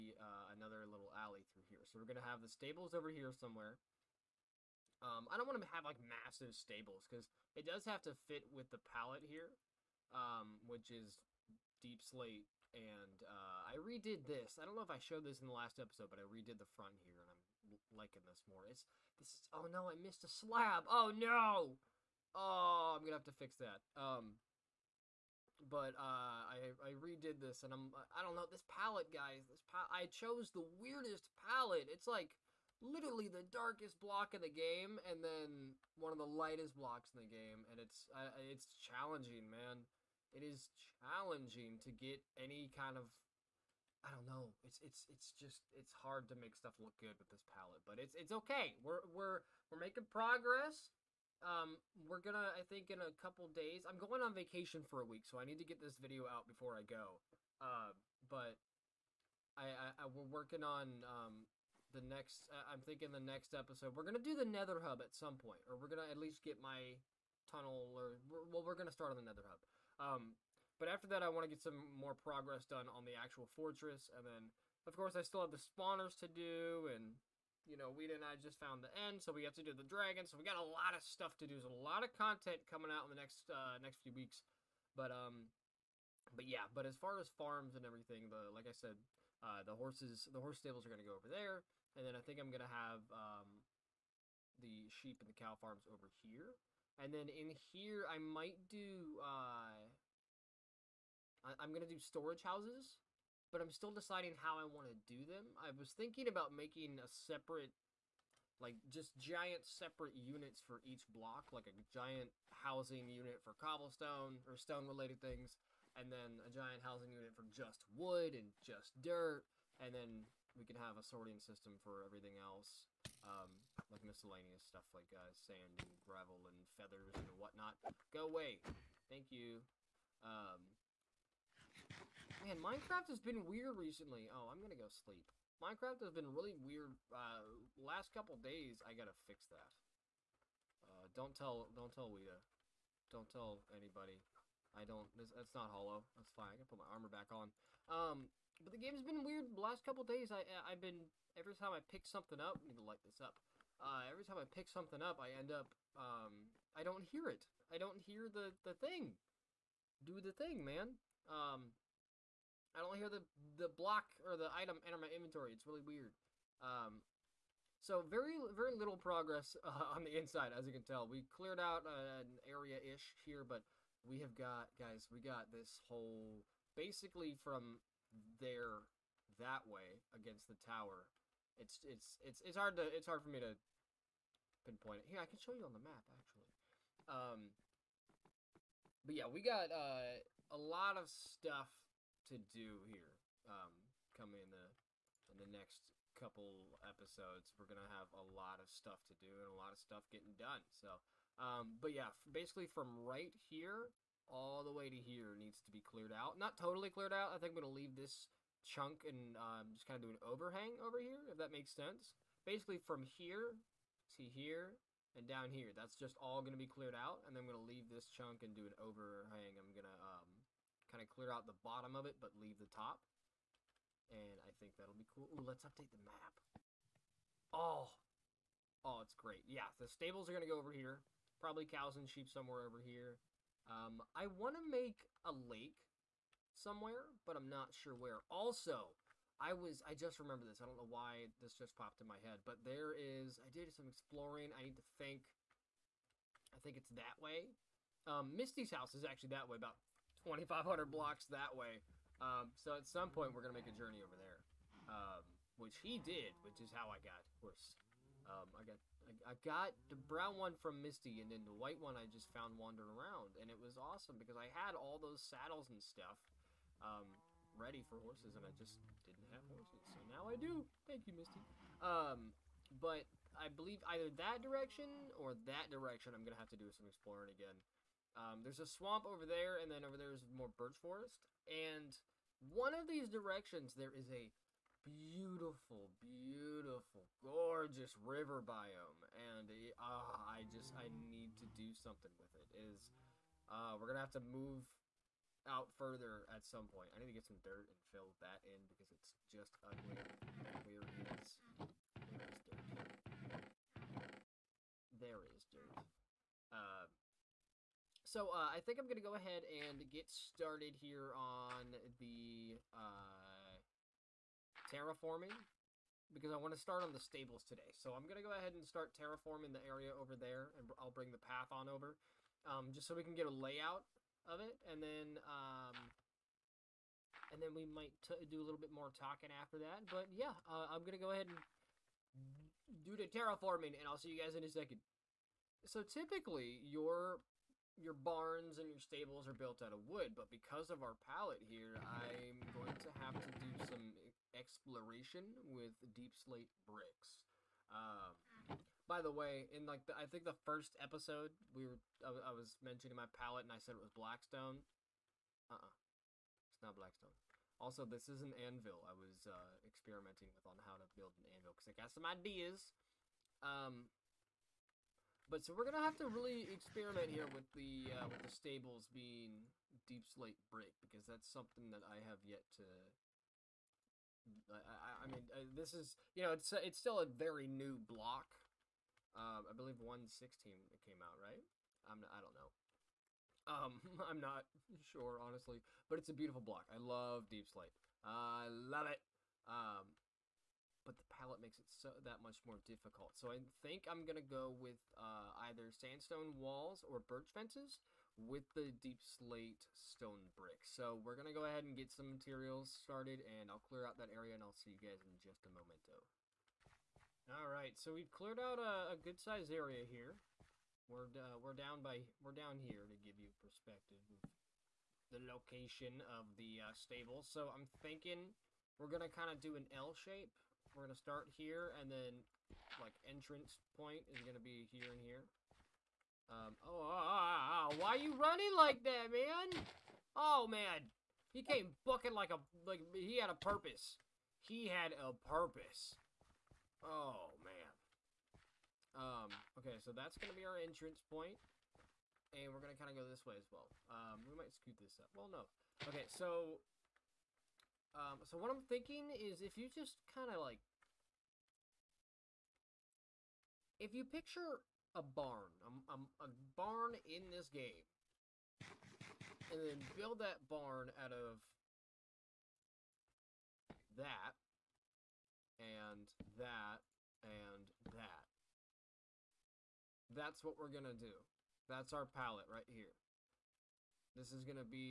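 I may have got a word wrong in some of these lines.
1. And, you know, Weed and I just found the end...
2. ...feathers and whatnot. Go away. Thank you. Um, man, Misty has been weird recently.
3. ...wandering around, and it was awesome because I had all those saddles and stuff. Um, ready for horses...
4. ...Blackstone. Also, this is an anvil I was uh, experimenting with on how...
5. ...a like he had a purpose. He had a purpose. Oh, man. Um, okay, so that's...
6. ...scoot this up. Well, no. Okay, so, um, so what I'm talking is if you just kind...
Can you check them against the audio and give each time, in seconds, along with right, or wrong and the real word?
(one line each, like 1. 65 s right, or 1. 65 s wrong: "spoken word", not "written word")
1. 76 s right
2. 126 s wrong: "Minecraft", not "Misty"
3. 262 s right
4. 356 s right
5. 432 s right
6. 444 s wrong: "thinking", not "talking".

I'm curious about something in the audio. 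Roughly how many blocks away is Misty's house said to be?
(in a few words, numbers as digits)
2,500.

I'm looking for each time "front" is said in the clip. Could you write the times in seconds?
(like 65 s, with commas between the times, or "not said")
16 s.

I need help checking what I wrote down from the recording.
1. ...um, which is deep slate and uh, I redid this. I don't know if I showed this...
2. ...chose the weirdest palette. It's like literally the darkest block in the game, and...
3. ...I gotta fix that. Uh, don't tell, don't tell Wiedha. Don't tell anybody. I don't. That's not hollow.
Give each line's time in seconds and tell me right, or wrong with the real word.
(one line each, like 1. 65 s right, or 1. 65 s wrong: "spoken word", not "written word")
1. 10 s right
2. 30 s right
3. 138 s right.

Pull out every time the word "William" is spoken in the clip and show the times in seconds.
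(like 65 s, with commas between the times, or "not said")
not said.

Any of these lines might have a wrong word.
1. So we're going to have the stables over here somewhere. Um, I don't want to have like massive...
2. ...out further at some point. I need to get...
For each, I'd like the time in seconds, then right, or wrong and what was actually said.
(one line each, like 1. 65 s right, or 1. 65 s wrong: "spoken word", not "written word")
1. 1 s right
2. 295 s right.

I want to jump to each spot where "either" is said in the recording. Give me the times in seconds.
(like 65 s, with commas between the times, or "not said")
273 s, 395 s.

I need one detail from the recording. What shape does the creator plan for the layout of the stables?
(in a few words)
L shape.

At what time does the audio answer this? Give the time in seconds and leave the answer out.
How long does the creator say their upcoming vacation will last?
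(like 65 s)
55 s.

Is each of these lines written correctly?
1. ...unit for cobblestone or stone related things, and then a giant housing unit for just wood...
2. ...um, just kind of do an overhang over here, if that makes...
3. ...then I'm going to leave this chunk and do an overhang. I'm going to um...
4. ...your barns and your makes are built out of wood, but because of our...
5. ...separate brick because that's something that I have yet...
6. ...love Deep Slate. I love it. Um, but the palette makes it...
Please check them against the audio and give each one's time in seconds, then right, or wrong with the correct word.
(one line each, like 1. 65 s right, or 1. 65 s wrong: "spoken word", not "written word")
1. 113 s right
2. 209 s right
3. 217 s right
4. 337 s wrong: "stables", not "makes"
5. 370 s wrong: "slate", not "separate"
6. 386 s right.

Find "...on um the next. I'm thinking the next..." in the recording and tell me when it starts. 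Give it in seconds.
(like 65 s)
60 s.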